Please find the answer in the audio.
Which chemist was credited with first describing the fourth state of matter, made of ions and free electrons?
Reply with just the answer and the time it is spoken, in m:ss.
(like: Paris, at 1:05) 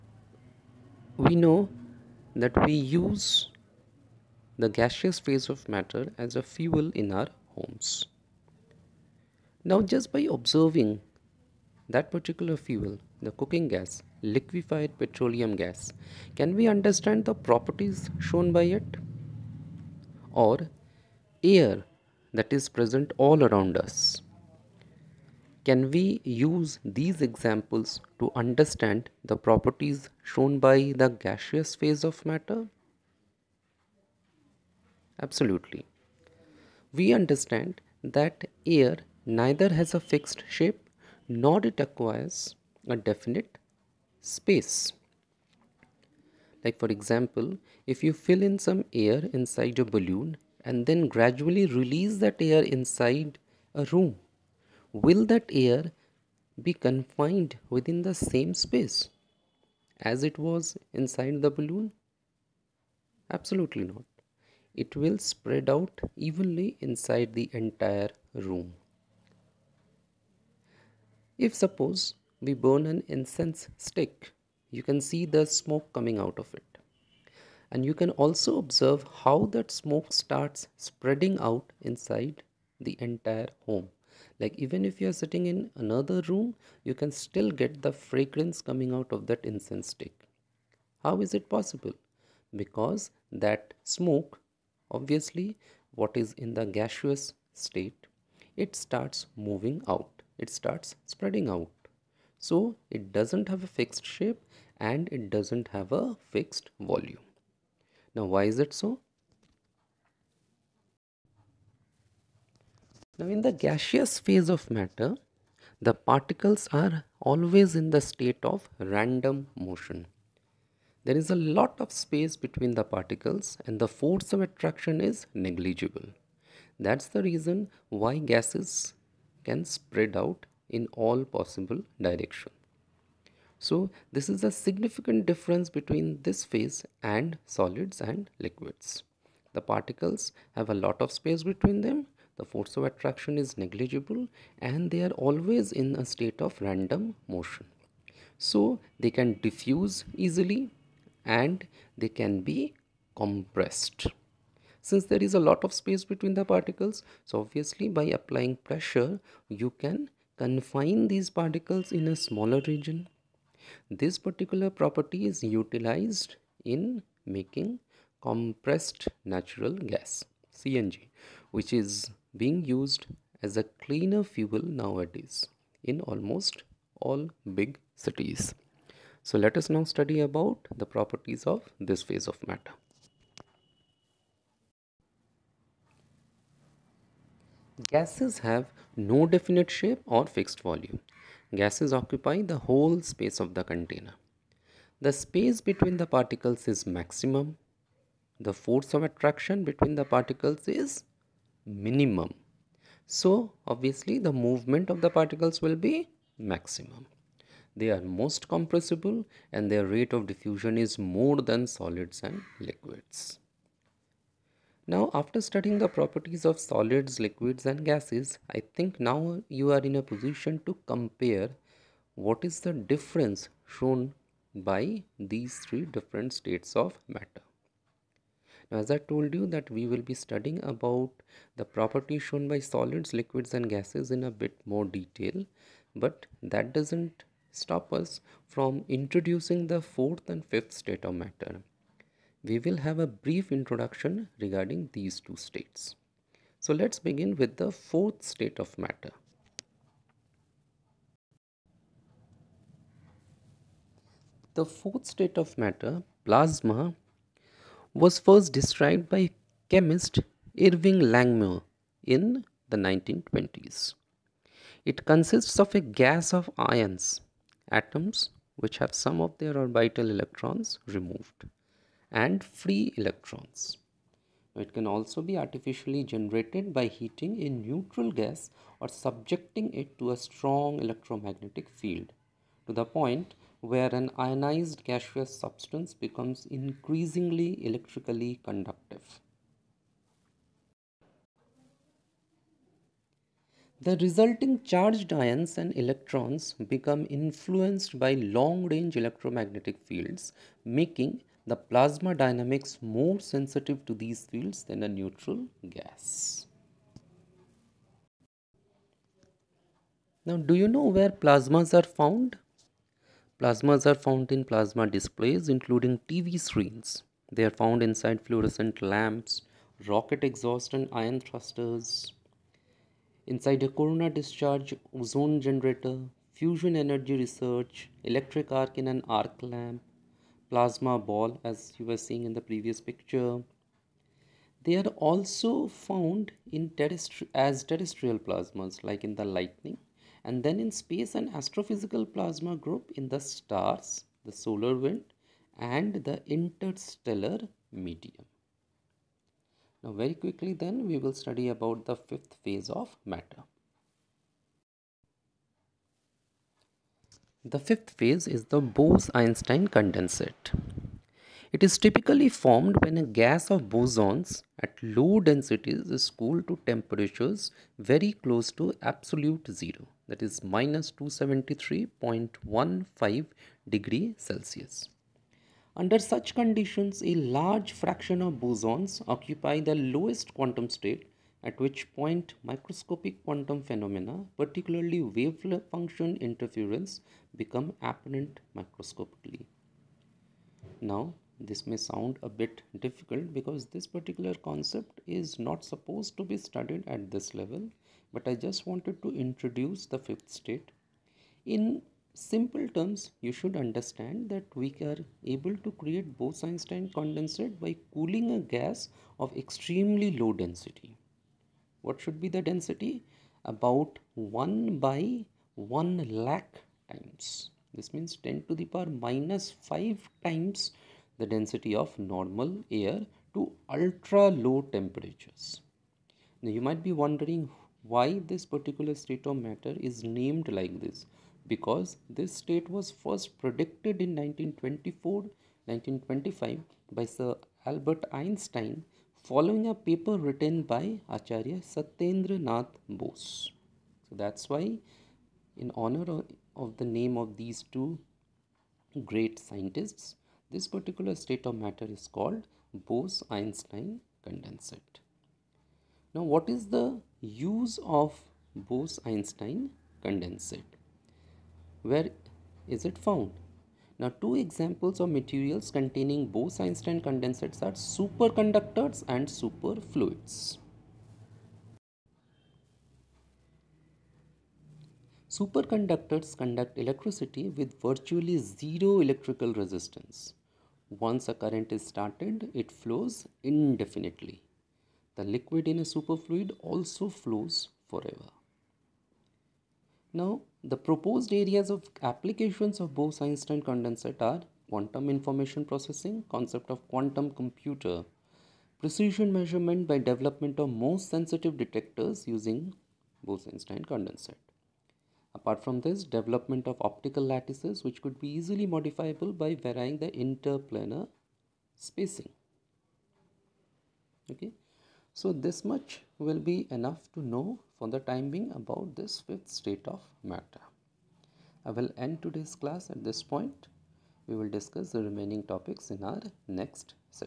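Irving Langmuir, at 4:20.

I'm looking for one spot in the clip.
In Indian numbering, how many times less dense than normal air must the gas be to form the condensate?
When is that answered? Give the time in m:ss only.
6:54.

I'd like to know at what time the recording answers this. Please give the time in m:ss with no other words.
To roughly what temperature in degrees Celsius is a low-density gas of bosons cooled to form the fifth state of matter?
6:10.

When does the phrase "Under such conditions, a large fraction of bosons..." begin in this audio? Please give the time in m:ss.
6:15.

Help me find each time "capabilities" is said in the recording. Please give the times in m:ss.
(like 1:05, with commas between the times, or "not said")
not said.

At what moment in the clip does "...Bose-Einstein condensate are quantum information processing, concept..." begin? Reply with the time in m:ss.
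8:12.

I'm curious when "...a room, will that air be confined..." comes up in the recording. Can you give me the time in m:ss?
0:53.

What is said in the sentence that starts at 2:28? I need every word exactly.
So they can diffuse easily and they can be compressed.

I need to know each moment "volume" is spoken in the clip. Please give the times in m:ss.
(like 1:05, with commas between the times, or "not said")
1:46, 3:10.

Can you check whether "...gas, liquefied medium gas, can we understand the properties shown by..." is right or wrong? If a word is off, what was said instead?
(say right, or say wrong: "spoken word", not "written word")
wrong: "petroleum", not "medium".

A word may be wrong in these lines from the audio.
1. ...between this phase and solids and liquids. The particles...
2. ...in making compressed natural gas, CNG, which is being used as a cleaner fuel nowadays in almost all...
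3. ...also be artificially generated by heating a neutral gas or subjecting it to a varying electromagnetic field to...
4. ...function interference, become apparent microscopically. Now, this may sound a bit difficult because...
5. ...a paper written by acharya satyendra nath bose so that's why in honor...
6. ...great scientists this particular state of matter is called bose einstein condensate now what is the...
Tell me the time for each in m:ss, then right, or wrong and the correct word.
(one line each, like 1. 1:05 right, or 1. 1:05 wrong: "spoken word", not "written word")
1. 2:15 right
2. 2:46 right
3. 4:34 wrong: "strong", not "varying"
4. 6:25 right
5. 7:19 right
6. 7:29 right.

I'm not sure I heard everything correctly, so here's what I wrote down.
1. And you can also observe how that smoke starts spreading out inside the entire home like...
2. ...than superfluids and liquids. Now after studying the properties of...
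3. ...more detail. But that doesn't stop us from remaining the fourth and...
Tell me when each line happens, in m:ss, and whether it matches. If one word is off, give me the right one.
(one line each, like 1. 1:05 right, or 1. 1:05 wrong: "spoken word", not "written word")
1. 1:17 right
2. 3:31 wrong: "solids", not "superfluids"
3. 3:54 wrong: "introducing", not "remaining".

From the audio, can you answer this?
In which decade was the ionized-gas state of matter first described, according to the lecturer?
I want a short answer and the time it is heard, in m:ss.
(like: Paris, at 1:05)
1920s, at 4:22.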